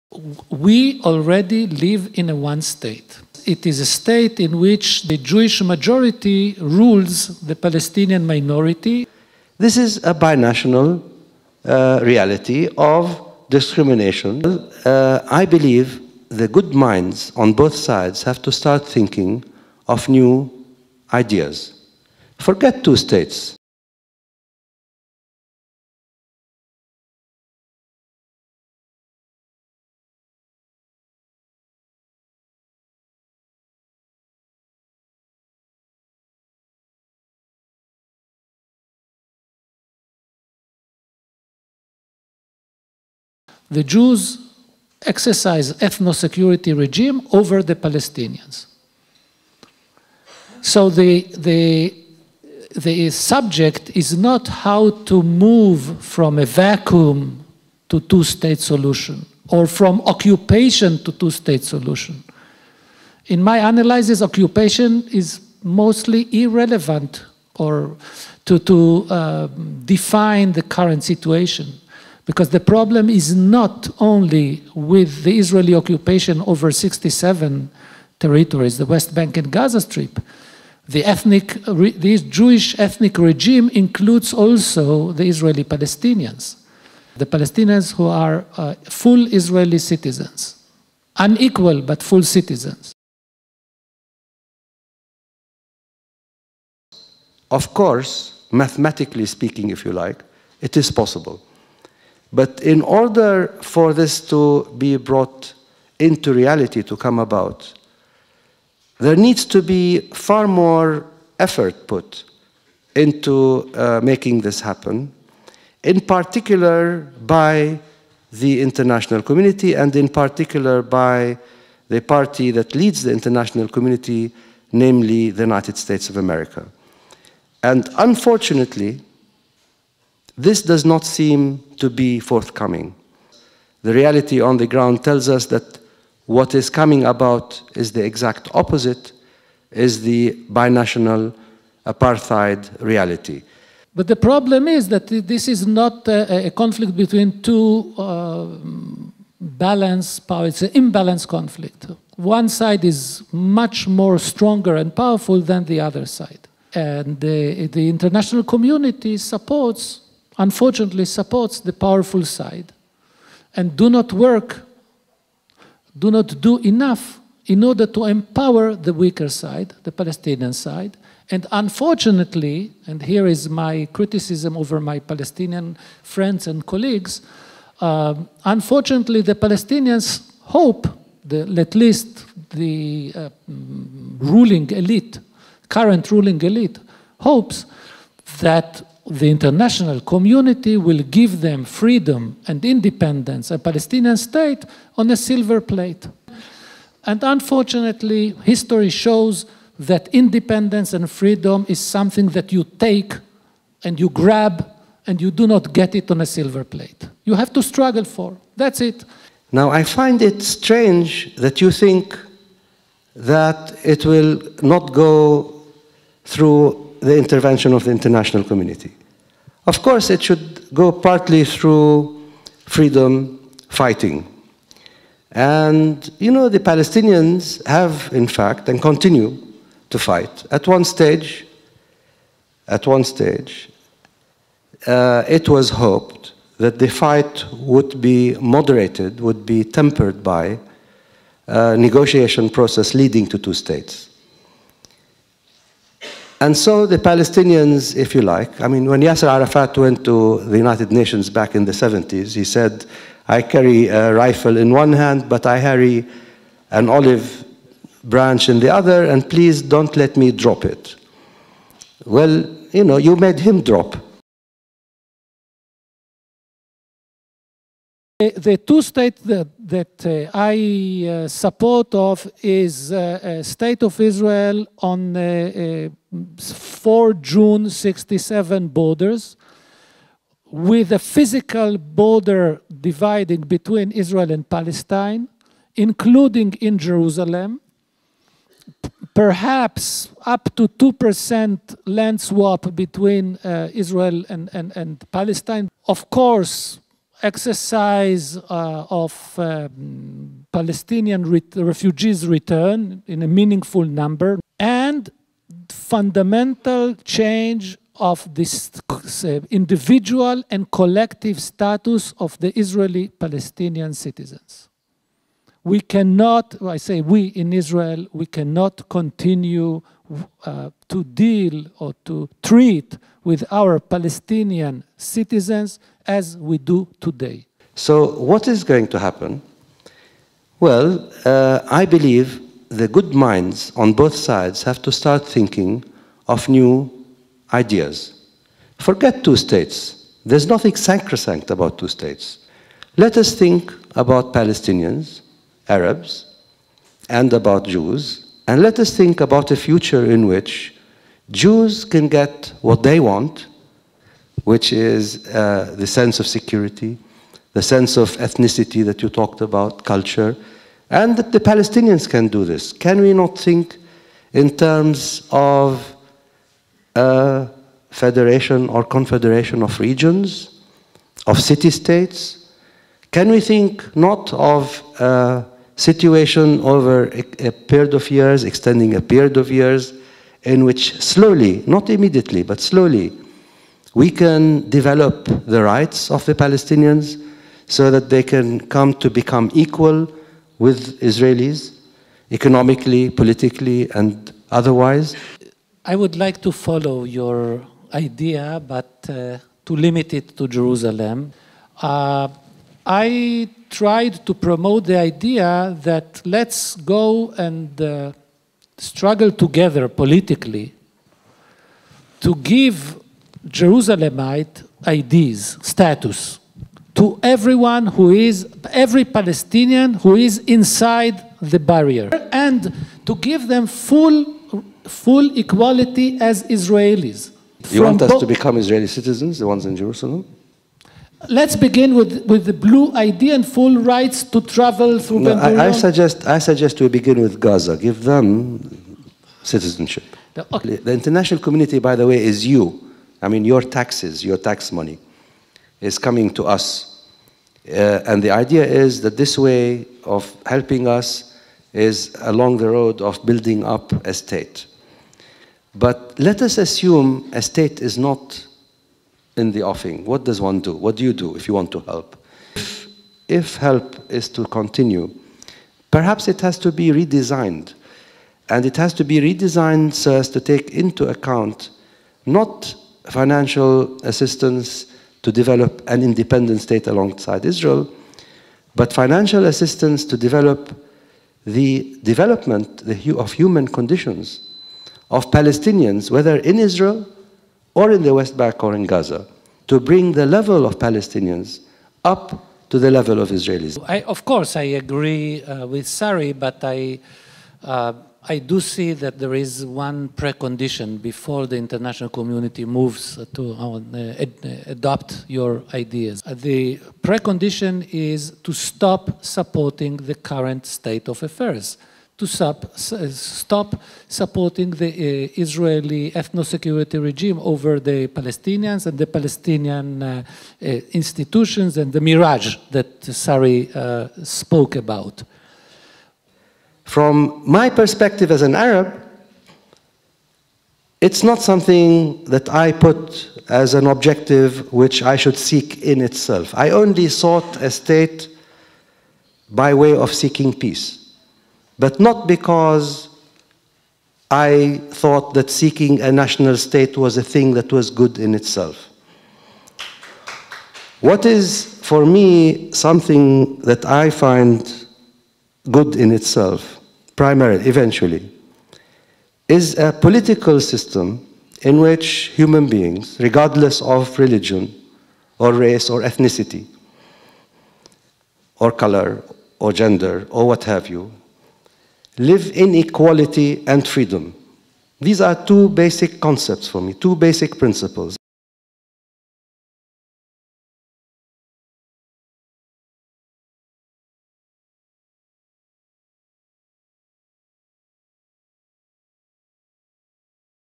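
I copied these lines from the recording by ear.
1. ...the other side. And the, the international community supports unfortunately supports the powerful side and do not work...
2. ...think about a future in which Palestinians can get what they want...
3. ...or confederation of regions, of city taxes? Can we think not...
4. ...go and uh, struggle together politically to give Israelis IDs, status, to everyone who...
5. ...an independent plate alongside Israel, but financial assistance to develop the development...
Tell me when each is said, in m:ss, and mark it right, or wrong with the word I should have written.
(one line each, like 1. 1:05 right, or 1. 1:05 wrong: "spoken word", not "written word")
1. 2:35 right
2. 5:48 wrong: "Jews", not "Palestinians"
3. 6:08 wrong: "states", not "taxes"
4. 6:46 wrong: "Jerusalemite", not "Israelis"
5. 7:55 wrong: "state", not "plate".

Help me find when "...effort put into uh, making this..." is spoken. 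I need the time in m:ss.
1:51.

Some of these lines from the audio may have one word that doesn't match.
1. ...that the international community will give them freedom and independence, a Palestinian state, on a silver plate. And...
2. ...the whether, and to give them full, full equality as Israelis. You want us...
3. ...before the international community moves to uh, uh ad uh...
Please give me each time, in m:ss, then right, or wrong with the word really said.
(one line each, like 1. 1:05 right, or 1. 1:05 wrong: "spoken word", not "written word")
1. 3:08 right
2. 7:01 wrong: "barrier", not "whether"
3. 8:21 right.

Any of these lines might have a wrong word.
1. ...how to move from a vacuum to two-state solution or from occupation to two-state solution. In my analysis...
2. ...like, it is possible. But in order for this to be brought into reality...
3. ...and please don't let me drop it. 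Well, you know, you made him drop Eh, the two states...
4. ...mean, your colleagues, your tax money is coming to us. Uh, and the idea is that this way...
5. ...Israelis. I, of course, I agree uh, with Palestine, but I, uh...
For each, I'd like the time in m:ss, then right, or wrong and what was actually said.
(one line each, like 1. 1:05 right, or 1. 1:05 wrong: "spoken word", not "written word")
1. 0:54 right
2. 1:39 right
3. 4:19 right
4. 7:23 wrong: "taxes", not "colleagues"
5. 8:13 wrong: "Sari", not "Palestine".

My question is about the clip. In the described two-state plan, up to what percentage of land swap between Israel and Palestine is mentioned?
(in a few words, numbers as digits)
2%.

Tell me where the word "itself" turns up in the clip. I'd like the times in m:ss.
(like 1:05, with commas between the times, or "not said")
8:56, 9:08, 9:16.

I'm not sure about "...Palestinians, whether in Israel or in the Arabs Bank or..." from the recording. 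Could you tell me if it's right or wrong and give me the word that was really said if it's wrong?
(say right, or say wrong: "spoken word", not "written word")
wrong: "West", not "Arabs".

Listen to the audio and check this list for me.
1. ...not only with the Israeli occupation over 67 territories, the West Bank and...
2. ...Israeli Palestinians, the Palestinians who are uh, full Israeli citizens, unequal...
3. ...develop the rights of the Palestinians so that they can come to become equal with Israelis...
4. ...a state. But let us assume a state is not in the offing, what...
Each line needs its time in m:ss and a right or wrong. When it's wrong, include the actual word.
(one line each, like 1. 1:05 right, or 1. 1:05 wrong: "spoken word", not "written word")
1. 1:13 right
2. 1:25 right
3. 6:24 right
4. 7:34 right.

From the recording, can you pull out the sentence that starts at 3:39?
Of course, it should go partly through freedom fighting.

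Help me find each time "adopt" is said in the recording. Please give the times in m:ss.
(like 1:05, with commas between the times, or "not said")
8:24.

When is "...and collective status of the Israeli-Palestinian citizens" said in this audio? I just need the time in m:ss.
5:10.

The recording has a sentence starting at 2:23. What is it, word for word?
But the problem is that this is not a, a conflict between two uh, balanced powers, it's an imbalanced conflict.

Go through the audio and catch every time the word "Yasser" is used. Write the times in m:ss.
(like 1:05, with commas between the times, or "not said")
4:09.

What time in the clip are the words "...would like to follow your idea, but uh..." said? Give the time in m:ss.
6:35.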